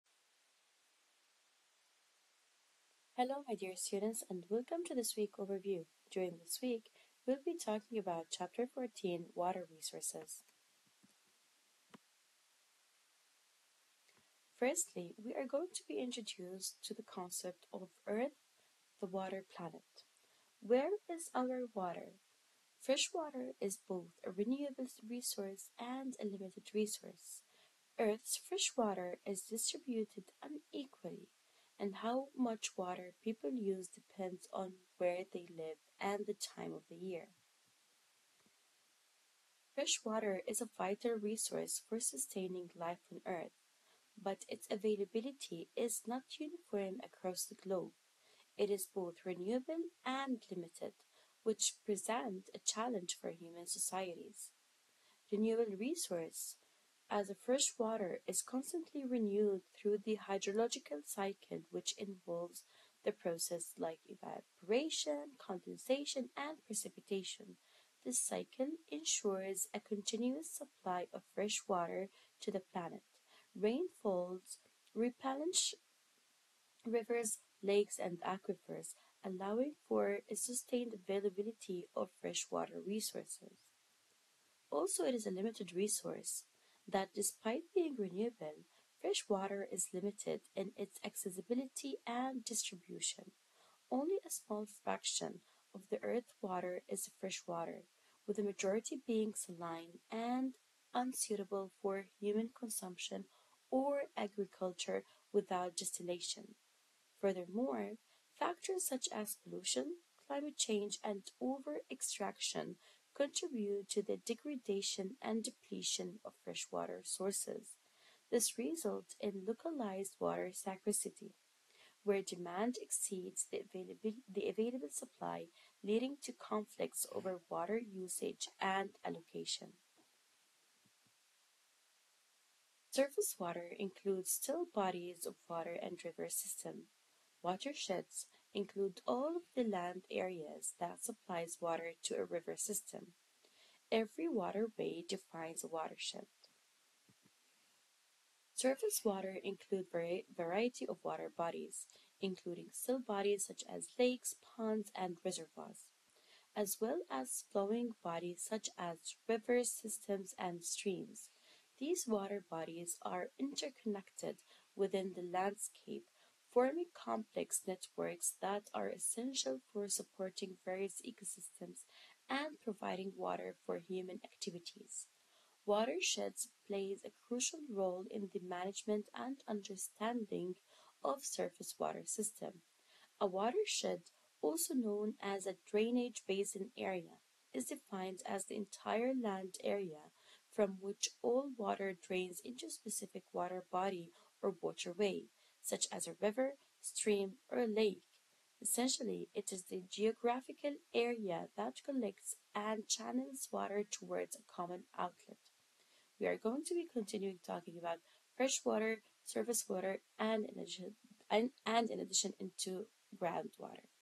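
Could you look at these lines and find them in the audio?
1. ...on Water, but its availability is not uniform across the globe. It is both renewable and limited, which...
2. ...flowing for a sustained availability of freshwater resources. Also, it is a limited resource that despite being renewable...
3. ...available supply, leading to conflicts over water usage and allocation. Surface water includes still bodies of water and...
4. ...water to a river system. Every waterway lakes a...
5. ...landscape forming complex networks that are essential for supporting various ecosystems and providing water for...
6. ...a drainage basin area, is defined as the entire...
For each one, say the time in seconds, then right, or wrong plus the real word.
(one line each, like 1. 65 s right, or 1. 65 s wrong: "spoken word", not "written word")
1. 43 s wrong: "Earth", not "Water"
2. 79 s wrong: "allowing", not "flowing"
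3. 124 s right
4. 141 s wrong: "defines", not "lakes"
5. 165 s right
6. 185 s right.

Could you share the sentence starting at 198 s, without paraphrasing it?
Essentially, it is the geographical area that collects and channels water towards a common outlet.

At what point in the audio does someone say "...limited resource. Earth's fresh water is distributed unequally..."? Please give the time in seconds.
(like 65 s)
26 s.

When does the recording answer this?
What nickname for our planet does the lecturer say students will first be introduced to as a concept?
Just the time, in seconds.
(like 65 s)
18 s.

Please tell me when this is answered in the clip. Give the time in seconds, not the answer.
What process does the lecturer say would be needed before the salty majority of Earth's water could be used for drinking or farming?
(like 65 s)
105 s.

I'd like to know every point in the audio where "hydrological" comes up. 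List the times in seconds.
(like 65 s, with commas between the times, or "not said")
60 s.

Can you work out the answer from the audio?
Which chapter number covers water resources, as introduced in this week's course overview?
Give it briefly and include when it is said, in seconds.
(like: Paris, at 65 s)
14, at 8 s.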